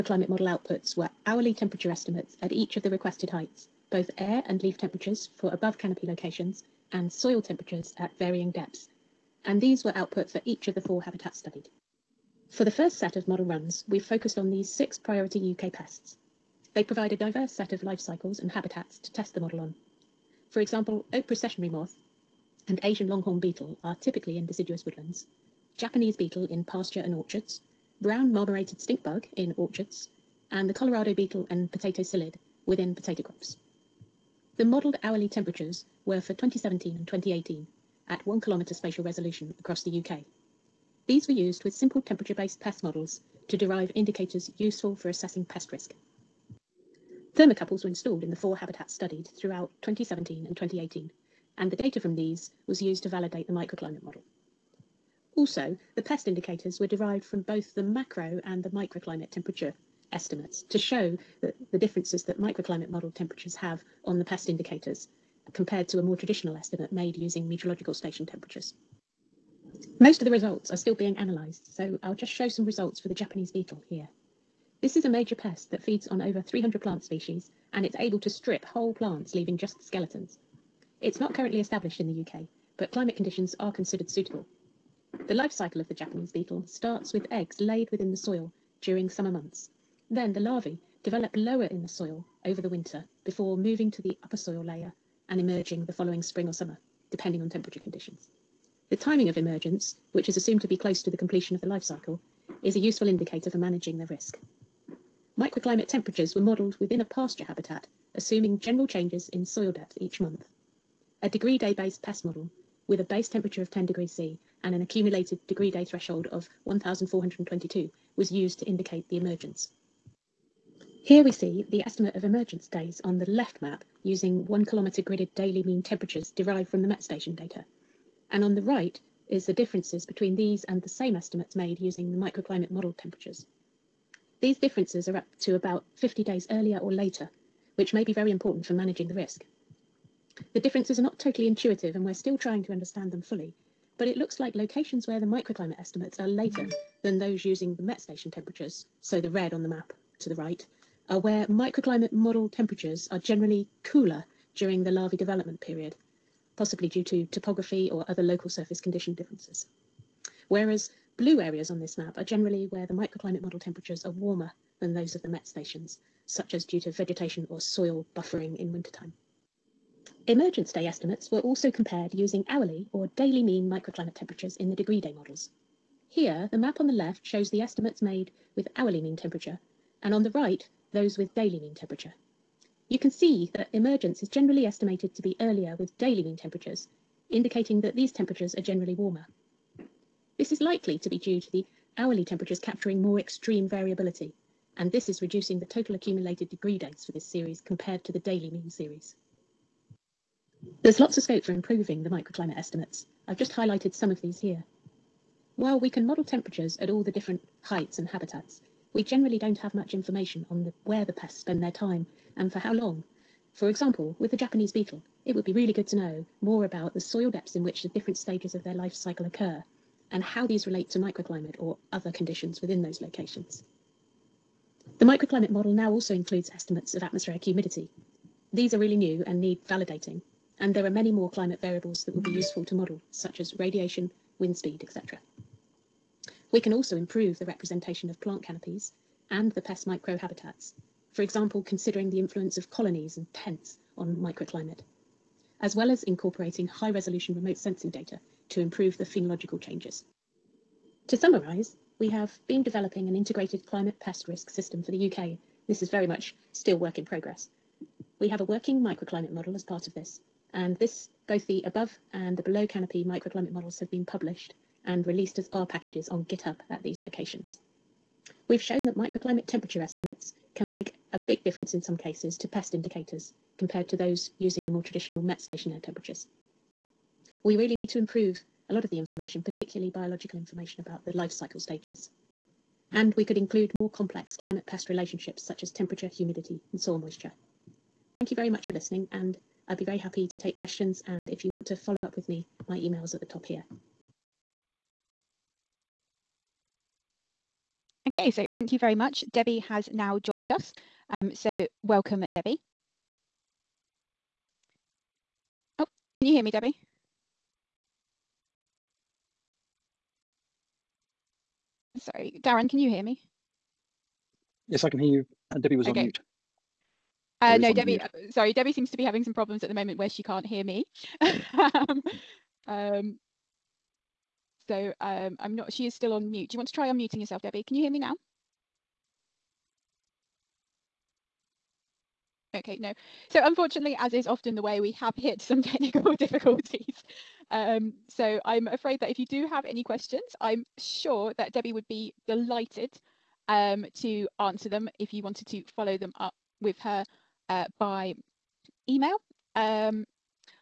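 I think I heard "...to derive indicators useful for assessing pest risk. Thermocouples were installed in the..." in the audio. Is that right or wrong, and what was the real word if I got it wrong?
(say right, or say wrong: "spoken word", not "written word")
right.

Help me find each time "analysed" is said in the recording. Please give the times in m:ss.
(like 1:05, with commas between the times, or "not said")
1:11.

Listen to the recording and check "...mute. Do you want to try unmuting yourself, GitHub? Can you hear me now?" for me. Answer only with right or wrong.
wrong.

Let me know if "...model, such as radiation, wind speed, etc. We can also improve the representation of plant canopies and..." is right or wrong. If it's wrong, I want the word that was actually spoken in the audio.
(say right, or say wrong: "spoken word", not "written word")
right.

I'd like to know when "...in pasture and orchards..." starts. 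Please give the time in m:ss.
0:26.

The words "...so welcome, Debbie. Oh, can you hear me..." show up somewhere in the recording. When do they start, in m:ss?
5:01.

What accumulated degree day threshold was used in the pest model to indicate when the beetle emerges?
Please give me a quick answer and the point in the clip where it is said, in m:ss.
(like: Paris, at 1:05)
1422, at 1:56.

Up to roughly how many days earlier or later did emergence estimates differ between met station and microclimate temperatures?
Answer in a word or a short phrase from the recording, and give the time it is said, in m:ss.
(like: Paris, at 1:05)
about 50 days, at 2:15.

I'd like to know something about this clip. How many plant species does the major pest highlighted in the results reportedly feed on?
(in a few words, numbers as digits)
over 300.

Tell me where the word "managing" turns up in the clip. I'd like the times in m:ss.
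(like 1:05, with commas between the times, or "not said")
1:43, 2:18.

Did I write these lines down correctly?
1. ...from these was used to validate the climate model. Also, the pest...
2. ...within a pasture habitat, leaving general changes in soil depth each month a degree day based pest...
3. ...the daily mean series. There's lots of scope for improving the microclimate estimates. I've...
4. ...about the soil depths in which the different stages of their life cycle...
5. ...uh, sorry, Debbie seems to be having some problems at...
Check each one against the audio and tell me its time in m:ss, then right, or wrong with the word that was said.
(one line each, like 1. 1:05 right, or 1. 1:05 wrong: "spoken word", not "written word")
1. 0:51 wrong: "microclimate", not "climate"
2. 1:46 wrong: "assuming", not "leaving"
3. 3:18 right
4. 3:36 right
5. 5:17 right.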